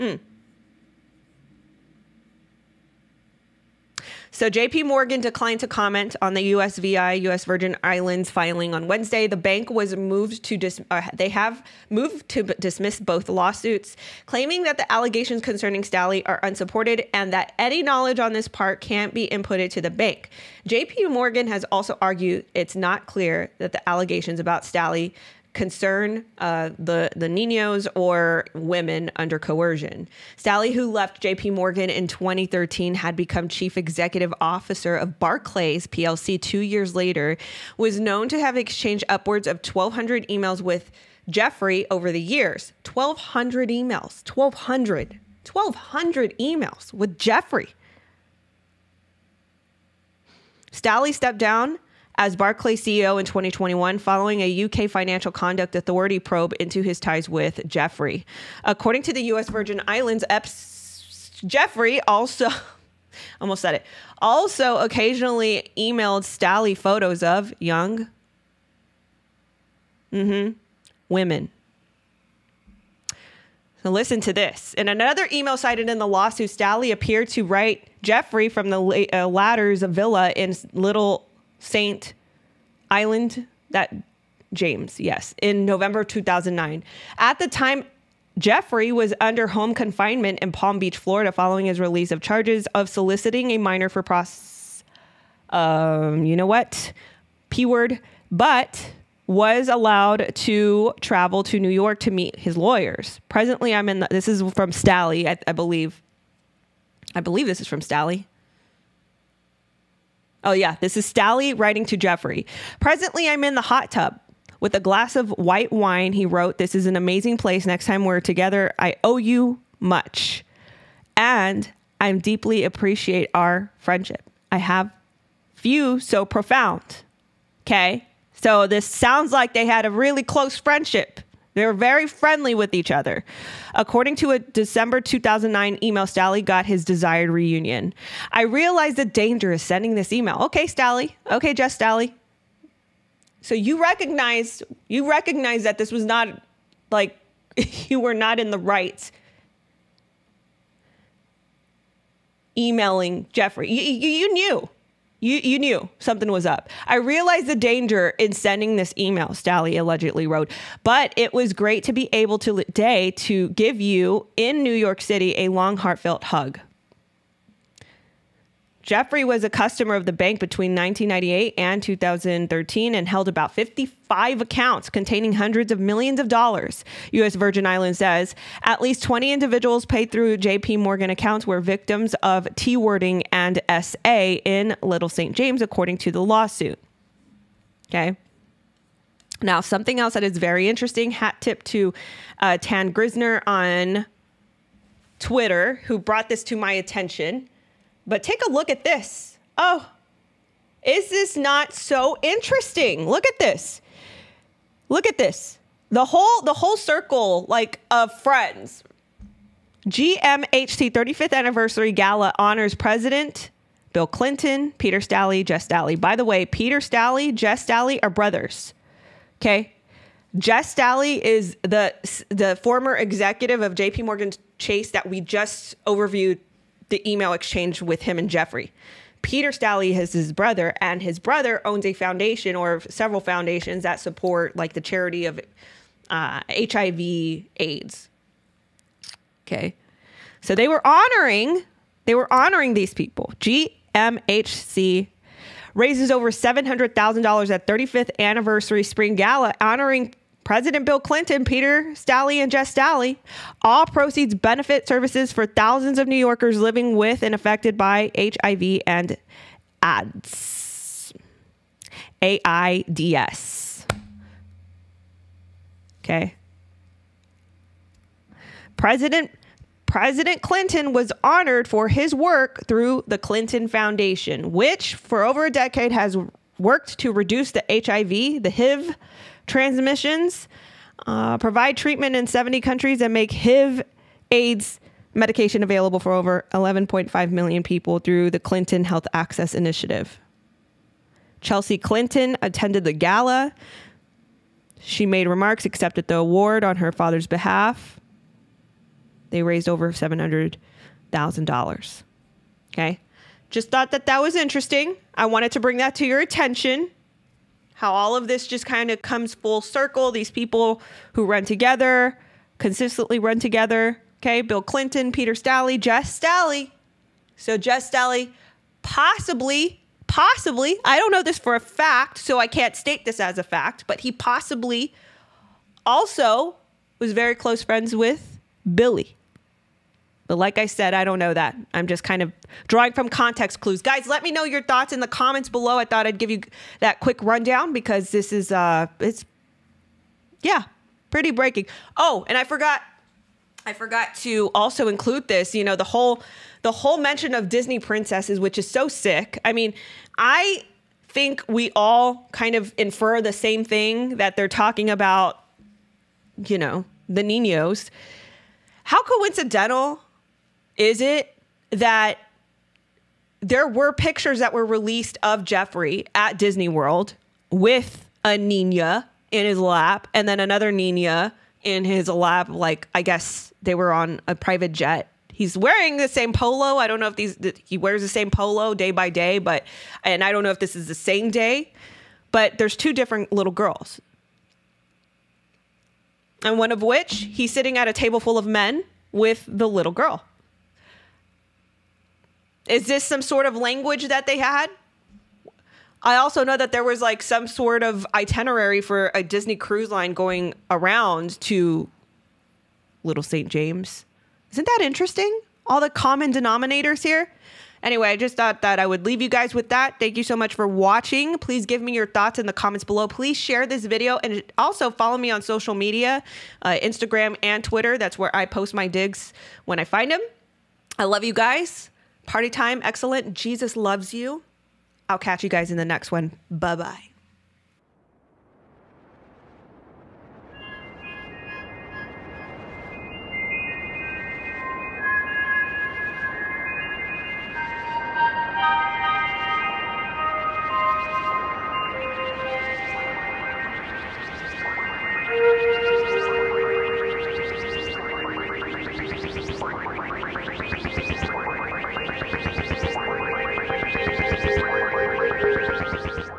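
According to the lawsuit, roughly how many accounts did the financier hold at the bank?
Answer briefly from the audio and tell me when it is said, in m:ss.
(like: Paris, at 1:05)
55, at 2:53.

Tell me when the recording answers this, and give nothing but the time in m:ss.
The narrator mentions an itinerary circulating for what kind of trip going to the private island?
6:39.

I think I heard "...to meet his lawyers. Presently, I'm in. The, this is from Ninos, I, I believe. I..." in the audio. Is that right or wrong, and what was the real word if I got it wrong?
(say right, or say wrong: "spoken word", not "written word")
wrong: "Staley", not "Ninos".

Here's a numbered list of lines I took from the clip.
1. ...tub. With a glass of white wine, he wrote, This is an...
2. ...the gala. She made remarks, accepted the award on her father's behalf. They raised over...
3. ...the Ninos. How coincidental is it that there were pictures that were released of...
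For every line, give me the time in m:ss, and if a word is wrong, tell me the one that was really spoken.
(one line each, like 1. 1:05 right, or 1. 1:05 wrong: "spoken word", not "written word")
1. 1:53 right
2. 4:52 right
3. 5:57 right.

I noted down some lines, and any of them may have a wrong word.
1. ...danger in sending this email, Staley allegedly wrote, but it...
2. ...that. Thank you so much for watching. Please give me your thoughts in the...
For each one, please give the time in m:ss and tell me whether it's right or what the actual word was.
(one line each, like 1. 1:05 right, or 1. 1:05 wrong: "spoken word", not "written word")
1. 2:37 right
2. 6:49 right.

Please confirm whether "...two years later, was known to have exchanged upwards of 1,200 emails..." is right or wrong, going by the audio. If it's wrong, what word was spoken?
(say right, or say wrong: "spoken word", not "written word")
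right.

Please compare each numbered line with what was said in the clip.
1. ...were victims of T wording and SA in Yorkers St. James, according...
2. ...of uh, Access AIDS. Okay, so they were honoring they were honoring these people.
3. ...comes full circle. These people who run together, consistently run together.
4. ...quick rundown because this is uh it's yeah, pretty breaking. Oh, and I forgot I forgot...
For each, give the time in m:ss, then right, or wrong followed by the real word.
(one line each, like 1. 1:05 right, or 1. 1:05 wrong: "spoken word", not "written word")
1. 3:01 wrong: "Little", not "Yorkers"
2. 3:55 wrong: "HIV", not "Access"
3. 5:09 right
4. 5:36 right.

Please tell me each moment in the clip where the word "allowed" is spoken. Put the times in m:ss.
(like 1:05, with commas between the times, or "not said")
1:39.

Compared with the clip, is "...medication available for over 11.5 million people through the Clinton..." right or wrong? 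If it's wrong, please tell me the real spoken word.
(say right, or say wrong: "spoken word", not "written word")
right.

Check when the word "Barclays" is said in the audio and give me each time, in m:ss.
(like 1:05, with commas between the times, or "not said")
0:35, 0:52.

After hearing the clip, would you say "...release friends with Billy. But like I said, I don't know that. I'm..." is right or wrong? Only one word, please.
wrong.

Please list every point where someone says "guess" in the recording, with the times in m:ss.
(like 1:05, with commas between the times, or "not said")
6:13.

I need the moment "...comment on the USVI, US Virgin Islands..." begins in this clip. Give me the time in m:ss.
0:05.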